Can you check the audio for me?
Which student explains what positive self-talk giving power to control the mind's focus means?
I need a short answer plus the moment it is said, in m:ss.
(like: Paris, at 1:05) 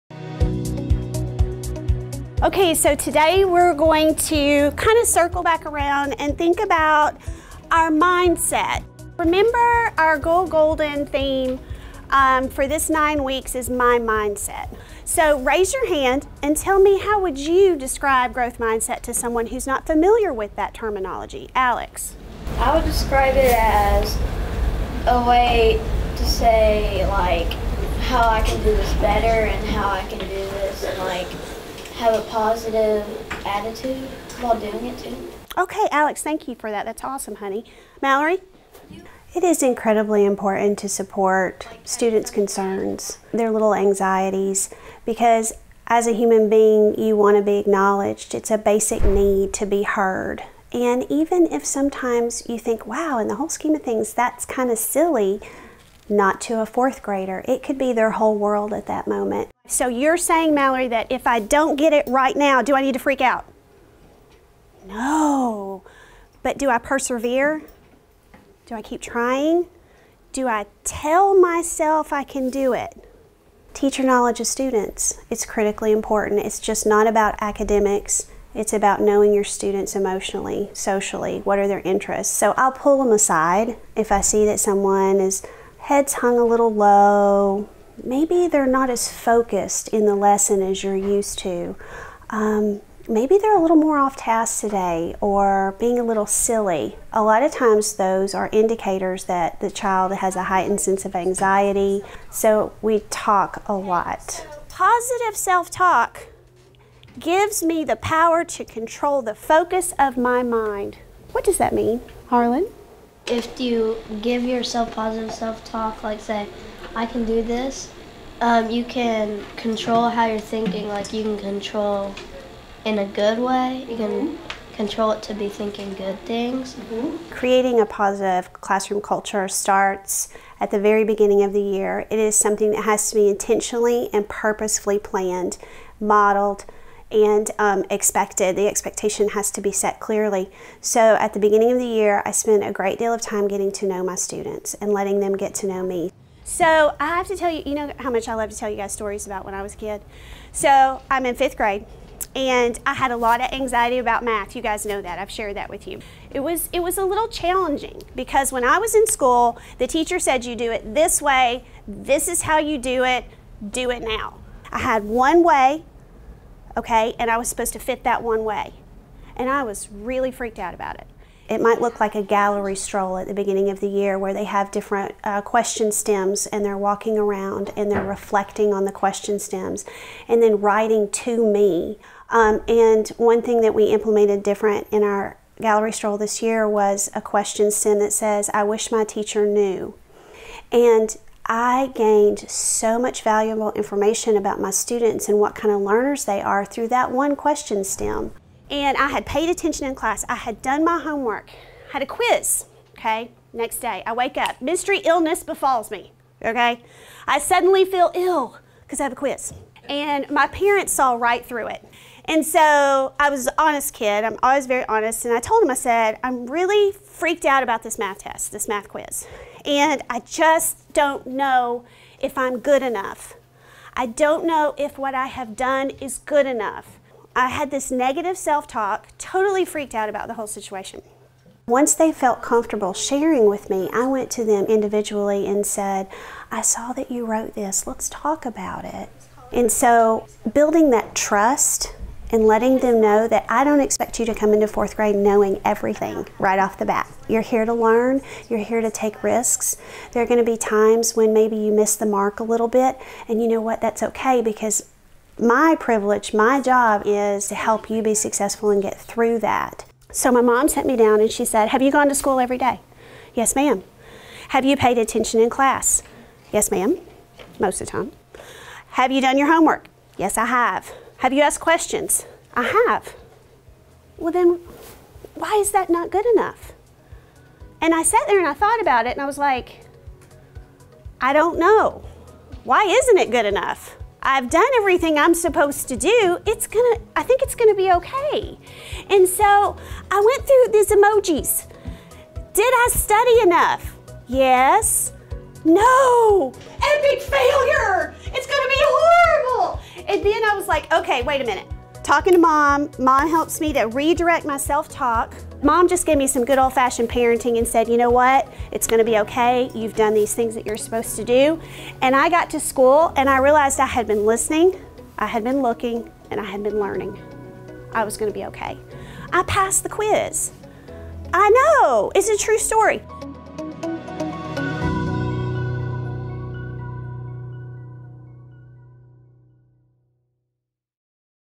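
Harlan, at 1:52.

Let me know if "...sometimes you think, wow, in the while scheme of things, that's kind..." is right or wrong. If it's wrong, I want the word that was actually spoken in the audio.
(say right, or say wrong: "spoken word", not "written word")
wrong: "whole", not "while".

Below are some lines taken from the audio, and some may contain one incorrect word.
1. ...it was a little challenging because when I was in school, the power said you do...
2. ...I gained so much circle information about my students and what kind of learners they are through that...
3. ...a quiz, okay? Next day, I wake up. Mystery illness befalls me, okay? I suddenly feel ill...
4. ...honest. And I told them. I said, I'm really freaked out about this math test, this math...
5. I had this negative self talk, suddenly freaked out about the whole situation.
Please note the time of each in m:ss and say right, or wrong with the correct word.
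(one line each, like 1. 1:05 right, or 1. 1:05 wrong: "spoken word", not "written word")
1. 2:36 wrong: "teacher", not "power"
2. 3:11 wrong: "valuable", not "circle"
3. 3:22 right
4. 3:34 right
5. 3:47 wrong: "totally", not "suddenly".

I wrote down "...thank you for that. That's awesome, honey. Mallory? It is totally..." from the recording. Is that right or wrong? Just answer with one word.
wrong.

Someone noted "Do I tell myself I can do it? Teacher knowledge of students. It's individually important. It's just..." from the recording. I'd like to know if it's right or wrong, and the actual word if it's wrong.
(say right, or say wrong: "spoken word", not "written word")
wrong: "critically", not "individually".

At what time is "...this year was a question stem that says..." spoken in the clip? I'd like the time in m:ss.
3:06.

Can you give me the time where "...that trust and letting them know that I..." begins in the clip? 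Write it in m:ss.
4:00.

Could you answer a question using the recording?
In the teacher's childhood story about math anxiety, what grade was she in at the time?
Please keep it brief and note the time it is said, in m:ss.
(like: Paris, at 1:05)
Fifth grade, at 2:31.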